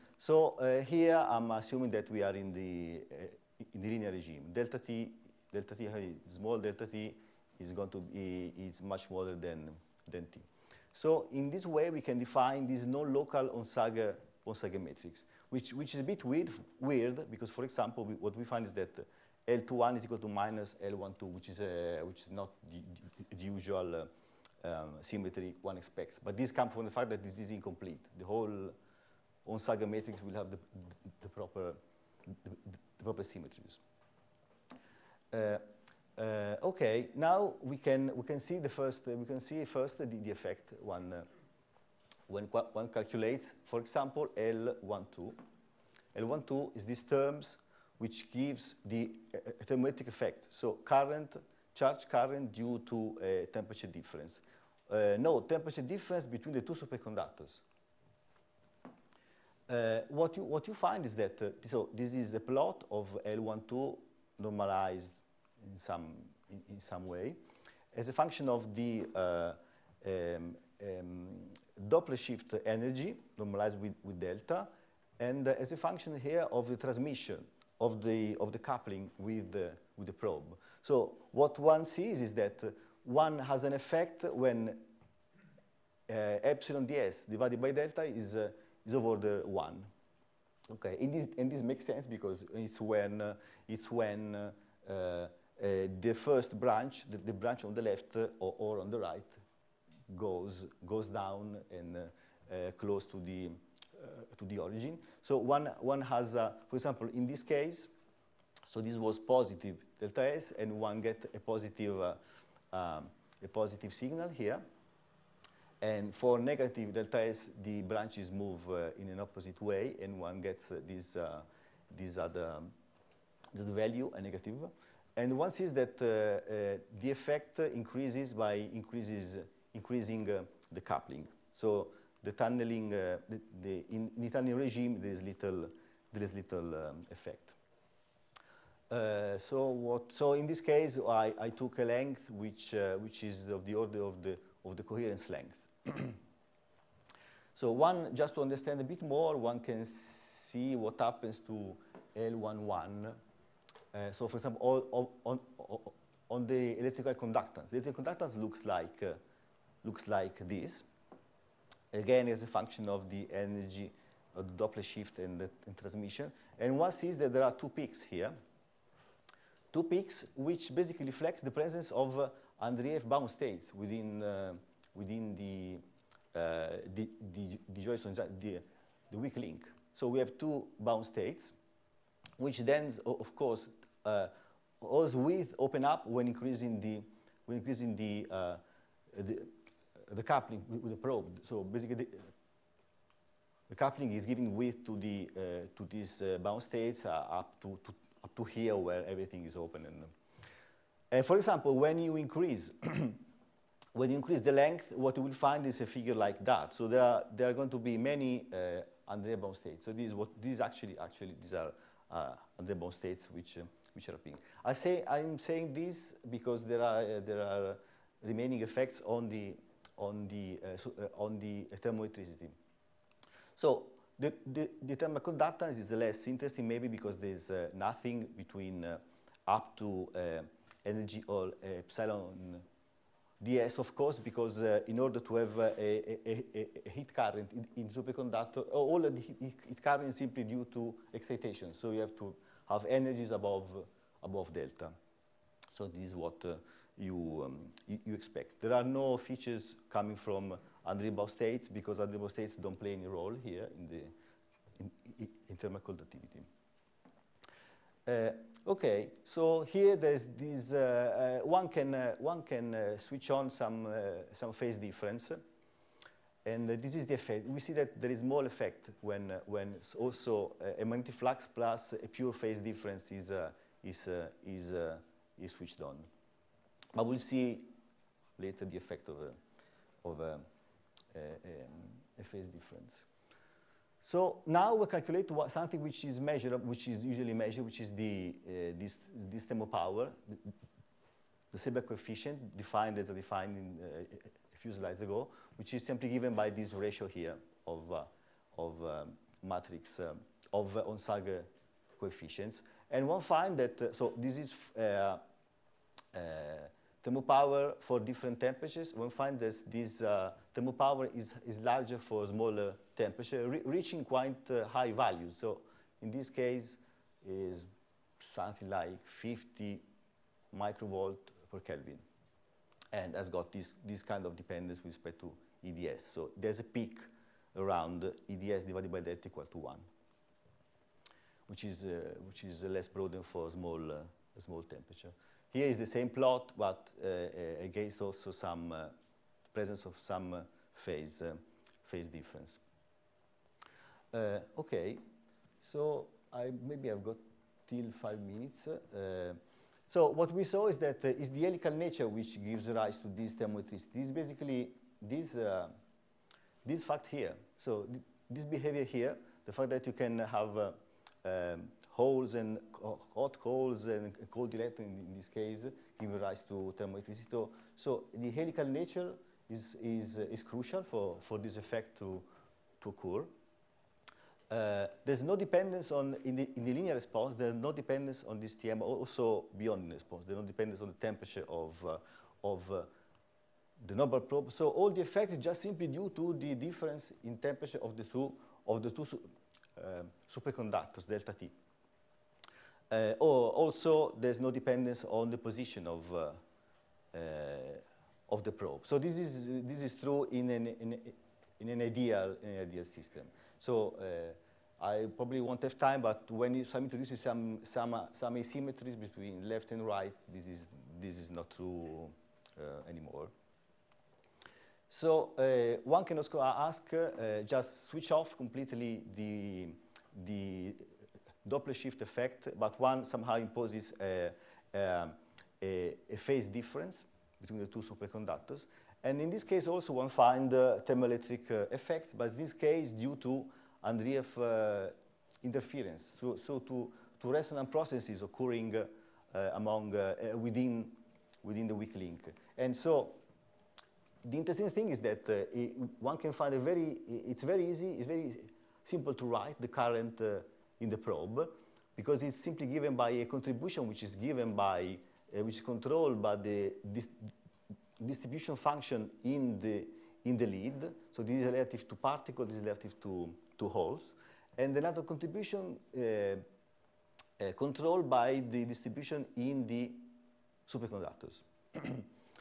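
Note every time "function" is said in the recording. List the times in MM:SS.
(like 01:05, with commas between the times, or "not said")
01:08, 01:15, 02:42, 07:38.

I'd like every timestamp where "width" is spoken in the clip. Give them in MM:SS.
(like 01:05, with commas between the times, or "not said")
03:05, 03:14.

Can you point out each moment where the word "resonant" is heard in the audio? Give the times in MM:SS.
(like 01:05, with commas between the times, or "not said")
07:17.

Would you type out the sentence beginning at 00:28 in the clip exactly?
The whole Onsager matrix will have the, the, the proper, the, the, proper symmetries.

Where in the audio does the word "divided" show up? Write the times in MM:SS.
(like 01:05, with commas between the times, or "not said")
01:27, 05:28.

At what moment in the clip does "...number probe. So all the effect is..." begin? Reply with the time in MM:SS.
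06:23.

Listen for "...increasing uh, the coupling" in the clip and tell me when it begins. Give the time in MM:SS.
02:09.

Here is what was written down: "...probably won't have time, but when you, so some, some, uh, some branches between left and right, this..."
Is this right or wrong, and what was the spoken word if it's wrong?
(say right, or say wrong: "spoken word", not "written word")
wrong: "asymmetries", not "branches".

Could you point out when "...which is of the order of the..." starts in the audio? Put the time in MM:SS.
02:22.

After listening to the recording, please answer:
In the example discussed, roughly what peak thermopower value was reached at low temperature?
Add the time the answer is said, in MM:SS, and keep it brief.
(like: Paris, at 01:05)
50 microvolts per Kelvin, at 05:19.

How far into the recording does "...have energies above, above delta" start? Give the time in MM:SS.
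04:02.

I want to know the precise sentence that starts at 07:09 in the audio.
And in this case also one find uh, thermoelectric uh, effects, but in this case due to Andreev uh, interference.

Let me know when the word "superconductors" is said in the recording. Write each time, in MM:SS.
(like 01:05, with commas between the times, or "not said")
00:56, 03:57, 06:30, 07:07, 07:50.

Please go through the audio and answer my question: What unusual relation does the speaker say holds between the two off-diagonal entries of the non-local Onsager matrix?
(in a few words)
L21 = -L12.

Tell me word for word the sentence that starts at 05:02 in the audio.
And one find that, uh, so this is uh, uh thermopower for different temperatures.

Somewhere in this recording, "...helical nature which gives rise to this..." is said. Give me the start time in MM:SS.
05:51.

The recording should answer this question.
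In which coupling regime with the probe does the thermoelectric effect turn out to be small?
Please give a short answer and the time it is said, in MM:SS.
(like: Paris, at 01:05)
tunneling regime, at 02:14.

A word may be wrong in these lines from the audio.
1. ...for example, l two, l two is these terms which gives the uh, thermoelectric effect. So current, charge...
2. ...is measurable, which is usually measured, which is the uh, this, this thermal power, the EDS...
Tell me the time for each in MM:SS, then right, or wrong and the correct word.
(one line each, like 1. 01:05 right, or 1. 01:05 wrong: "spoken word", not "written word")
1. 00:43 right
2. 04:46 wrong: "Seebeck", not "EDS".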